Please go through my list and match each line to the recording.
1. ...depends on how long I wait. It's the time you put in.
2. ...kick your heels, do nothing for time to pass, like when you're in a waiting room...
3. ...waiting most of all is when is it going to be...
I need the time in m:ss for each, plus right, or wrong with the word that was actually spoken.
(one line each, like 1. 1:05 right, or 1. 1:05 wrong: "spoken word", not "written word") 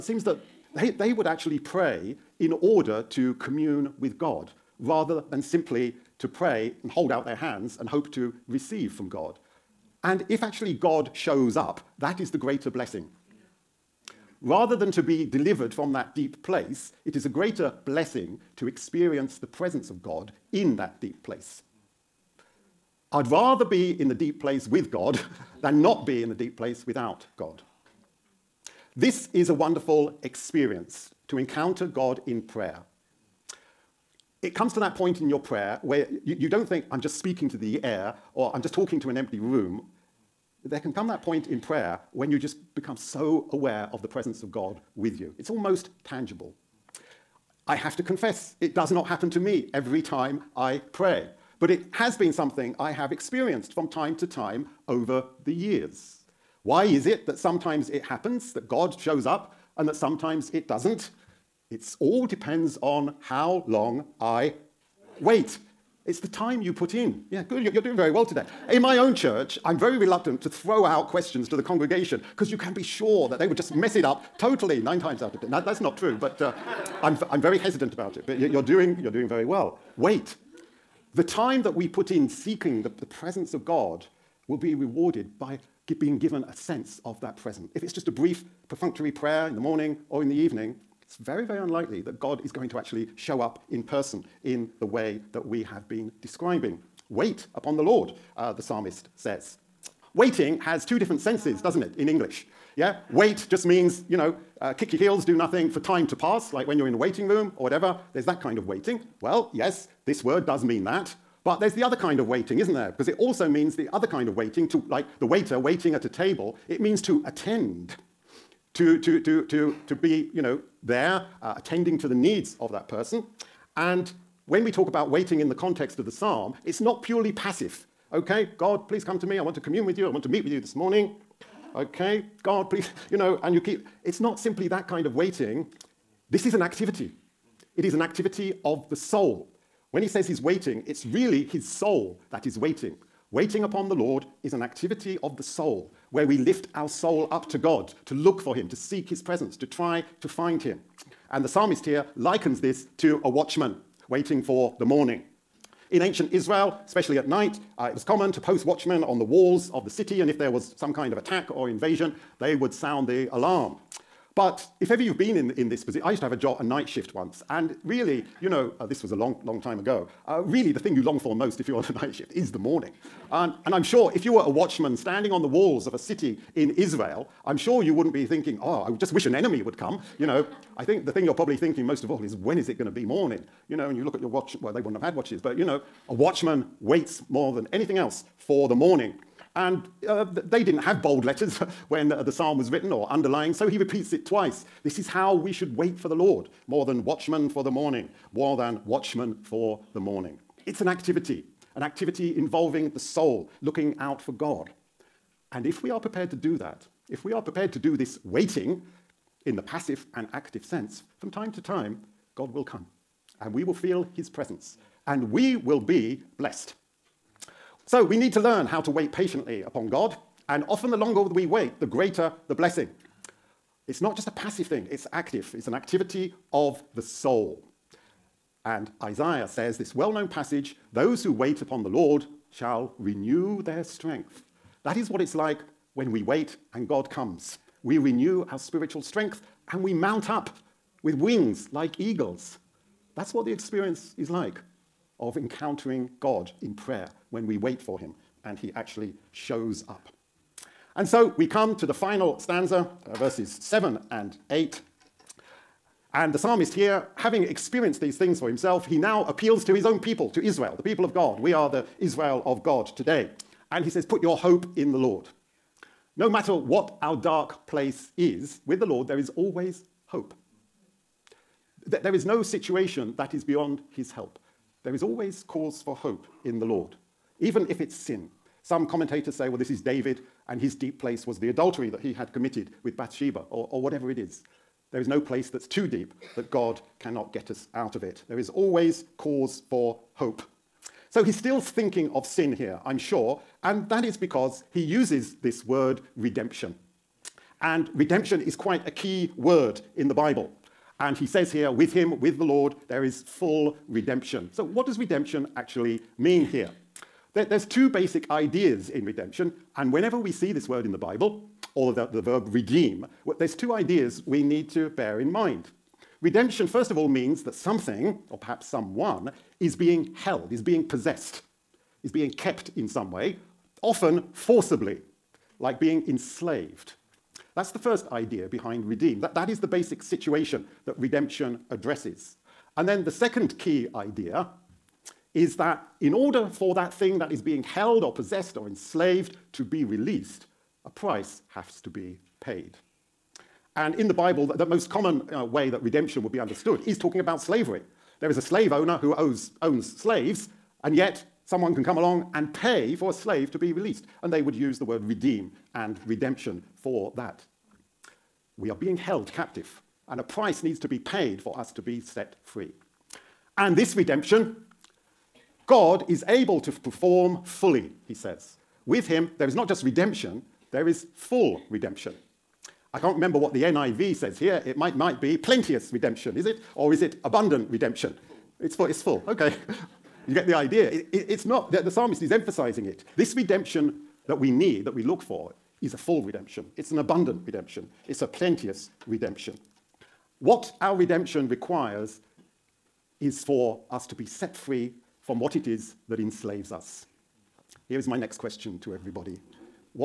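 1. 1:02 right
2. 1:44 right
3. 3:01 wrong: "thinking", not "waiting".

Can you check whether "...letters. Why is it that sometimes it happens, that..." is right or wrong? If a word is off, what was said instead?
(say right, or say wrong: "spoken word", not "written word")
wrong: "years", not "letters".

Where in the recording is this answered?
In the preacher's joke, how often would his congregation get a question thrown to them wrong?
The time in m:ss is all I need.
1:14.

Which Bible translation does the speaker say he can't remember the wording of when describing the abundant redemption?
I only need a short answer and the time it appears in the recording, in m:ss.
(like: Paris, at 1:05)
NIV, at 6:13.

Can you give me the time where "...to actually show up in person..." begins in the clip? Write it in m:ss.
1:32.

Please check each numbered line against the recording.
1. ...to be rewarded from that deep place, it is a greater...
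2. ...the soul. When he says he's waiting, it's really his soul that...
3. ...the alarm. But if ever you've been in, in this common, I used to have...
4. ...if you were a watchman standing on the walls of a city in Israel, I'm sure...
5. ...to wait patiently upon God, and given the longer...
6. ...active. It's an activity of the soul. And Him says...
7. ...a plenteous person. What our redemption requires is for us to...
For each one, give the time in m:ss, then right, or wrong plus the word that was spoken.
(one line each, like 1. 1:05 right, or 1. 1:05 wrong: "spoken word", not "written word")
1. 0:14 wrong: "delivered", not "rewarded"
2. 2:18 right
3. 2:43 wrong: "position", not "common"
4. 2:54 right
5. 3:38 wrong: "often", not "given"
6. 3:45 wrong: "Isaiah", not "Him"
7. 6:28 wrong: "redemption", not "person".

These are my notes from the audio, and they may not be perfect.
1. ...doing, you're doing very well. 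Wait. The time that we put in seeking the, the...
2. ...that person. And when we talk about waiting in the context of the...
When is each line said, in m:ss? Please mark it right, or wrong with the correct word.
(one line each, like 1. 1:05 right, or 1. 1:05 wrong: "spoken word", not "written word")
1. 1:18 right
2. 2:02 right.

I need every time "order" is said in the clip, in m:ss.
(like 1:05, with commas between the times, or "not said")
0:02, 5:36.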